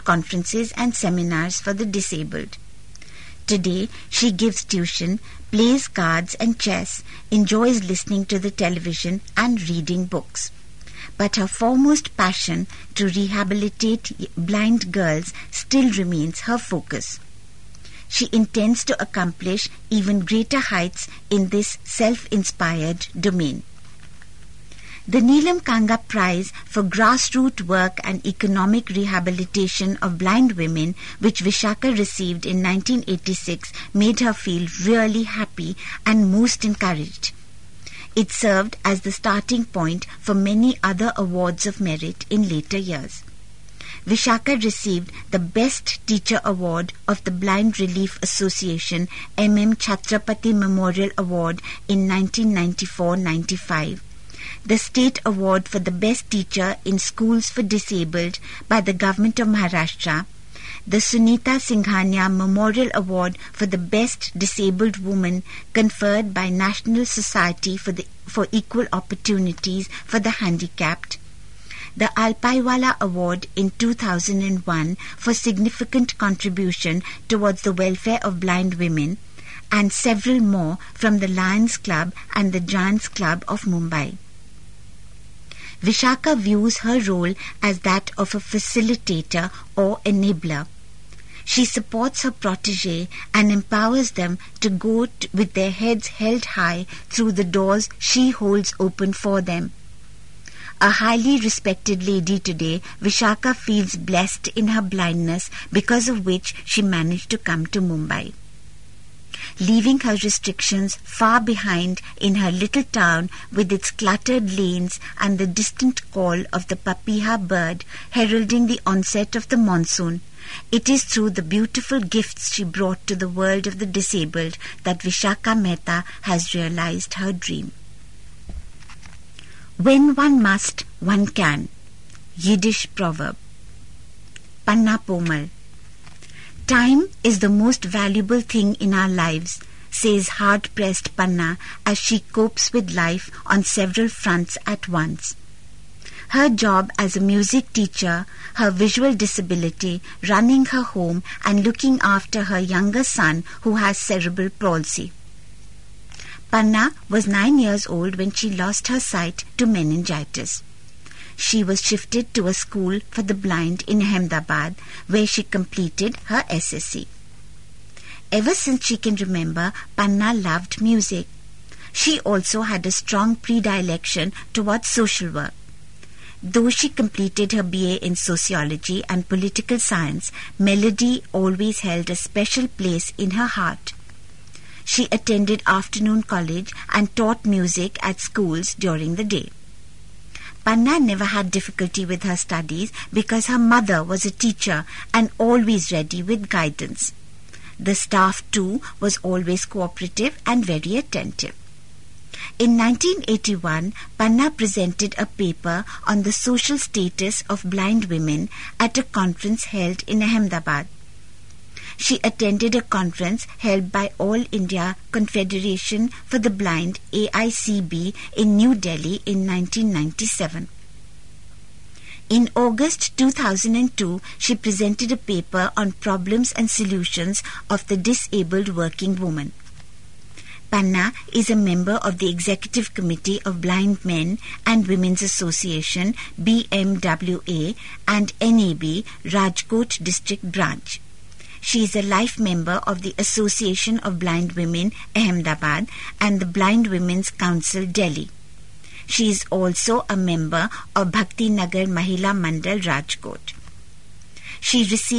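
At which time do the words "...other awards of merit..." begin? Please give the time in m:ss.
0:40.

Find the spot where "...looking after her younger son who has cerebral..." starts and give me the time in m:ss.
2:31.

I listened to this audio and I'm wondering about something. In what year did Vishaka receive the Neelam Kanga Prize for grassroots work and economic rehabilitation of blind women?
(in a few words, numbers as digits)
1986.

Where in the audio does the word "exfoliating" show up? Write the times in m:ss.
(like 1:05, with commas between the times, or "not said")
not said.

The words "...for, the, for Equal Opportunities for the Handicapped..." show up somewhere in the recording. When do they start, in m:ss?
1:07.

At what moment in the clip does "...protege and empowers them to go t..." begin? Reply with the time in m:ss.
1:32.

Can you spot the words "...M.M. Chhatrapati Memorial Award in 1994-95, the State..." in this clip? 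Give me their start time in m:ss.
0:49.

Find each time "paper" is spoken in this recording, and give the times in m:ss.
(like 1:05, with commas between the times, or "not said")
3:25, 3:45.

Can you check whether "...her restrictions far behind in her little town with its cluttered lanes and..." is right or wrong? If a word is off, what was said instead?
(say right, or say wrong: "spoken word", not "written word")
right.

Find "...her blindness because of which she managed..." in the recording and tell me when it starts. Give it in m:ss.
1:44.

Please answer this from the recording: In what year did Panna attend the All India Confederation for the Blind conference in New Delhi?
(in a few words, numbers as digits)
1997.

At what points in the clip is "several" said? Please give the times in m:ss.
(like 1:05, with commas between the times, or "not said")
1:19, 2:23.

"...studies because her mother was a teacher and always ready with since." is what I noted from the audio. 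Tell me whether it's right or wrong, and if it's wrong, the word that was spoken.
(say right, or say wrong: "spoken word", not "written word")
wrong: "guidance", not "since".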